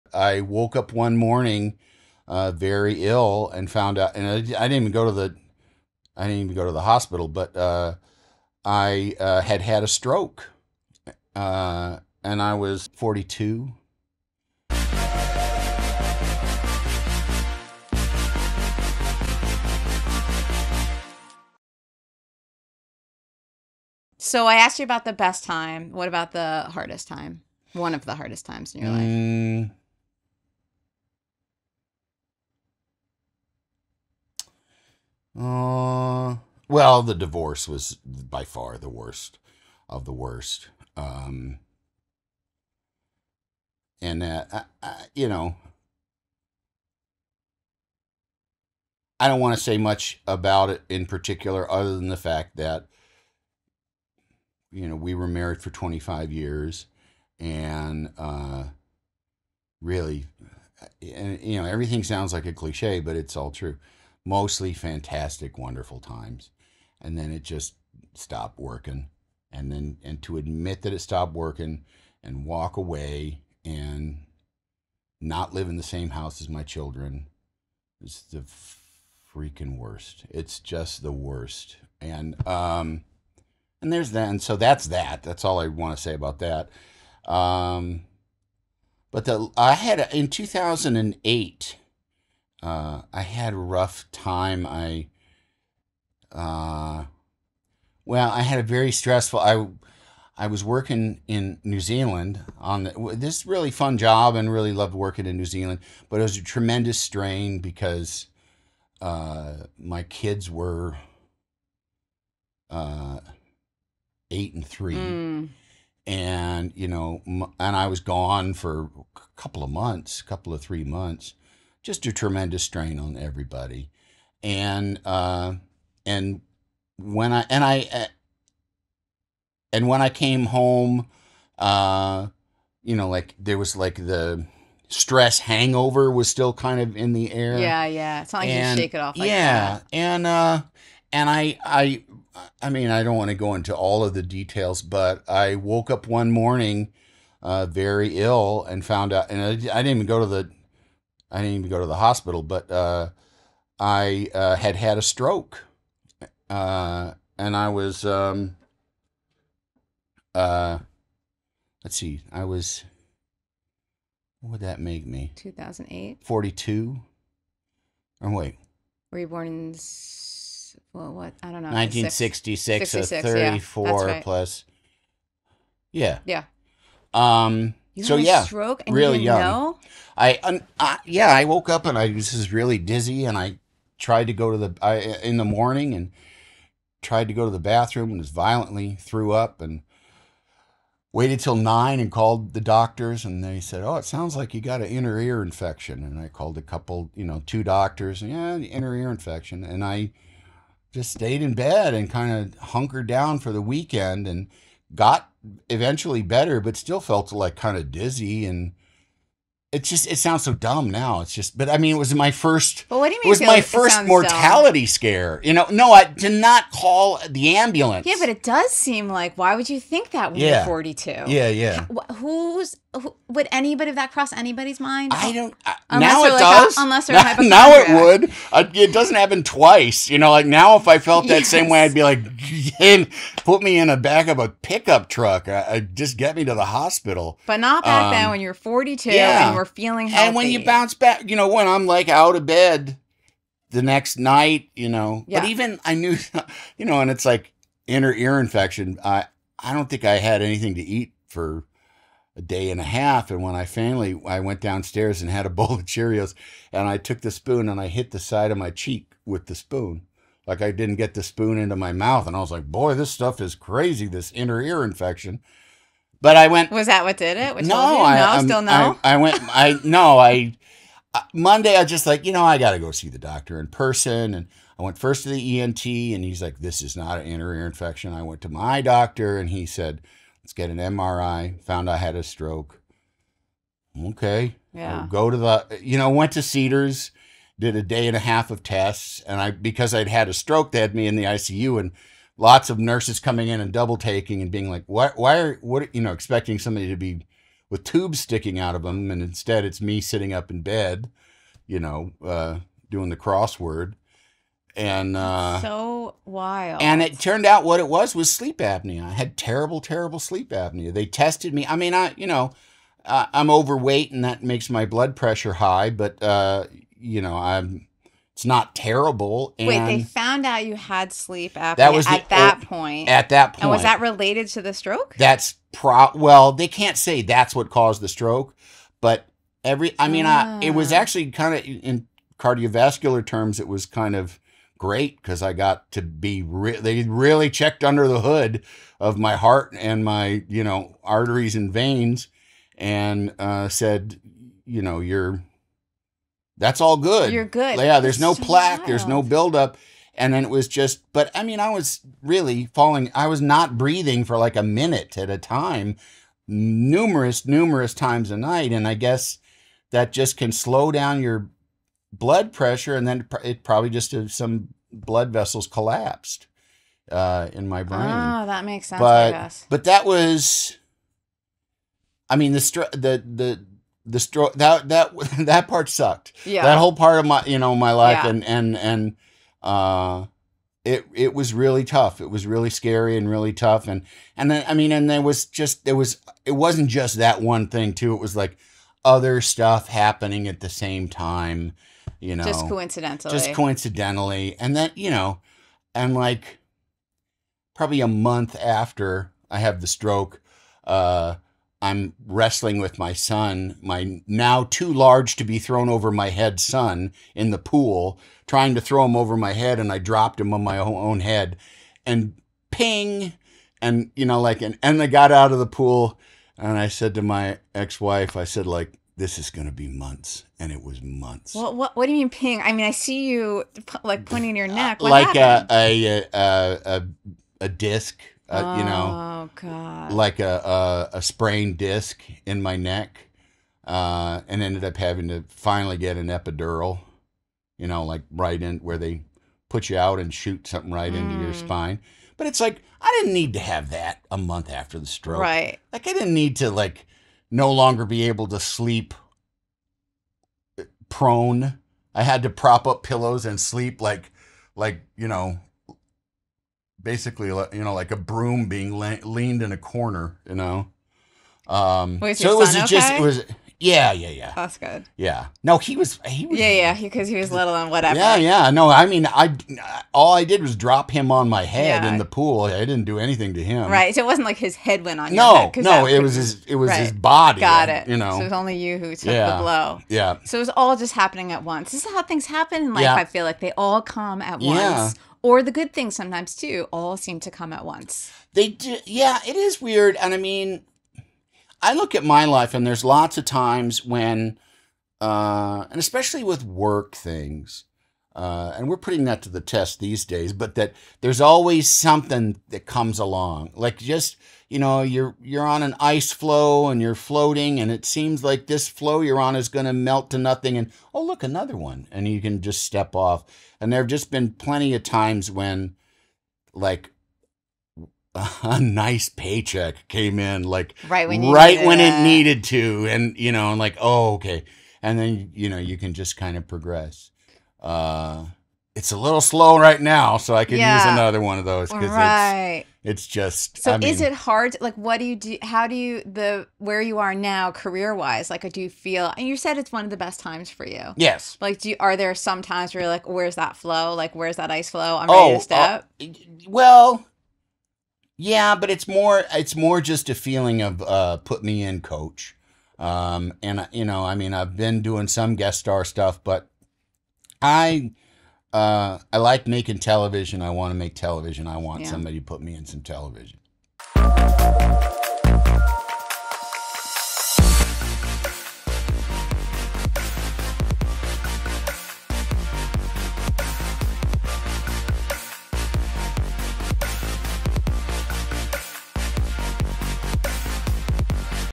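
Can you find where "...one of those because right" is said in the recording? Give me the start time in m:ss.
8:51.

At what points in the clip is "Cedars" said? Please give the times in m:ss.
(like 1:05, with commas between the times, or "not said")
4:46.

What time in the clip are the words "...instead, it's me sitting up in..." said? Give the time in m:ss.
4:59.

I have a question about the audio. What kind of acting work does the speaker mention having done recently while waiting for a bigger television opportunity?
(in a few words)
guest star.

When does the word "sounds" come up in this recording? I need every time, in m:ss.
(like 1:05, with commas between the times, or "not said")
1:02, 3:14, 3:30.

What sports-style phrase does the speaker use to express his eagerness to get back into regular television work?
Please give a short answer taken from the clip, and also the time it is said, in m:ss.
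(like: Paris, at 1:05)
put me in, coach, at 9:11.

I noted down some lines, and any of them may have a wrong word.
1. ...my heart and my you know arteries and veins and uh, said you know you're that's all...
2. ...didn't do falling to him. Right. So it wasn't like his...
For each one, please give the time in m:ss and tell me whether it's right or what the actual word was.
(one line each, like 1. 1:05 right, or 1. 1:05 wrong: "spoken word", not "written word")
1. 5:39 right
2. 7:52 wrong: "anything", not "falling".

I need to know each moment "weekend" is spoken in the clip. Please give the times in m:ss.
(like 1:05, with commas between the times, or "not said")
3:23.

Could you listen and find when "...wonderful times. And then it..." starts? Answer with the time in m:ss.
1:05.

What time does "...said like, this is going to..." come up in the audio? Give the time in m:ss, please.
6:58.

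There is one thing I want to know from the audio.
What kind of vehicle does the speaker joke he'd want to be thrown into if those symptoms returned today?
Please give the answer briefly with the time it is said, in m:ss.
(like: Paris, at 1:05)
pickup truck, at 3:54.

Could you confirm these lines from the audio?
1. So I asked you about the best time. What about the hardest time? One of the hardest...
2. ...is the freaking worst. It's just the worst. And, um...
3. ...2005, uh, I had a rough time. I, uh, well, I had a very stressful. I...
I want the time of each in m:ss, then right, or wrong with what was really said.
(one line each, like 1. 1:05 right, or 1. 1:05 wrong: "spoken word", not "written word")
1. 0:24 right
2. 1:18 right
3. 1:30 wrong: "2008", not "2005".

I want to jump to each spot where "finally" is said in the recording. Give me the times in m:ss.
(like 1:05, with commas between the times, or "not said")
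4:13, 7:15.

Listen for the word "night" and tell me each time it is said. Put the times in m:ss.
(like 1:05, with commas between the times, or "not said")
4:04, 5:58.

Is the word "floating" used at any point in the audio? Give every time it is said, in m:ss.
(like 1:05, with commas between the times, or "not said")
8:27.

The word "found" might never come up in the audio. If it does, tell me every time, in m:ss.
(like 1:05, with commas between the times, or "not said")
0:03, 2:28, 4:41, 5:20.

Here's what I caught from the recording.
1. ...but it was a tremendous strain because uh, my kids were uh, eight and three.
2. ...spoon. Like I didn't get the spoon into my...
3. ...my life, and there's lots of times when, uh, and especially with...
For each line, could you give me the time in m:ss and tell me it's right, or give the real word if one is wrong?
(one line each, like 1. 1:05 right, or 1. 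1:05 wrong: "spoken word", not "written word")
1. 1:46 right
2. 4:19 right
3. 8:12 right.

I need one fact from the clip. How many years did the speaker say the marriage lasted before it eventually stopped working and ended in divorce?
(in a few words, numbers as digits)
25 years.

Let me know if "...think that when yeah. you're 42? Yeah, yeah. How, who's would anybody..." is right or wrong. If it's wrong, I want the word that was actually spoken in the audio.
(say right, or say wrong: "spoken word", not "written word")
right.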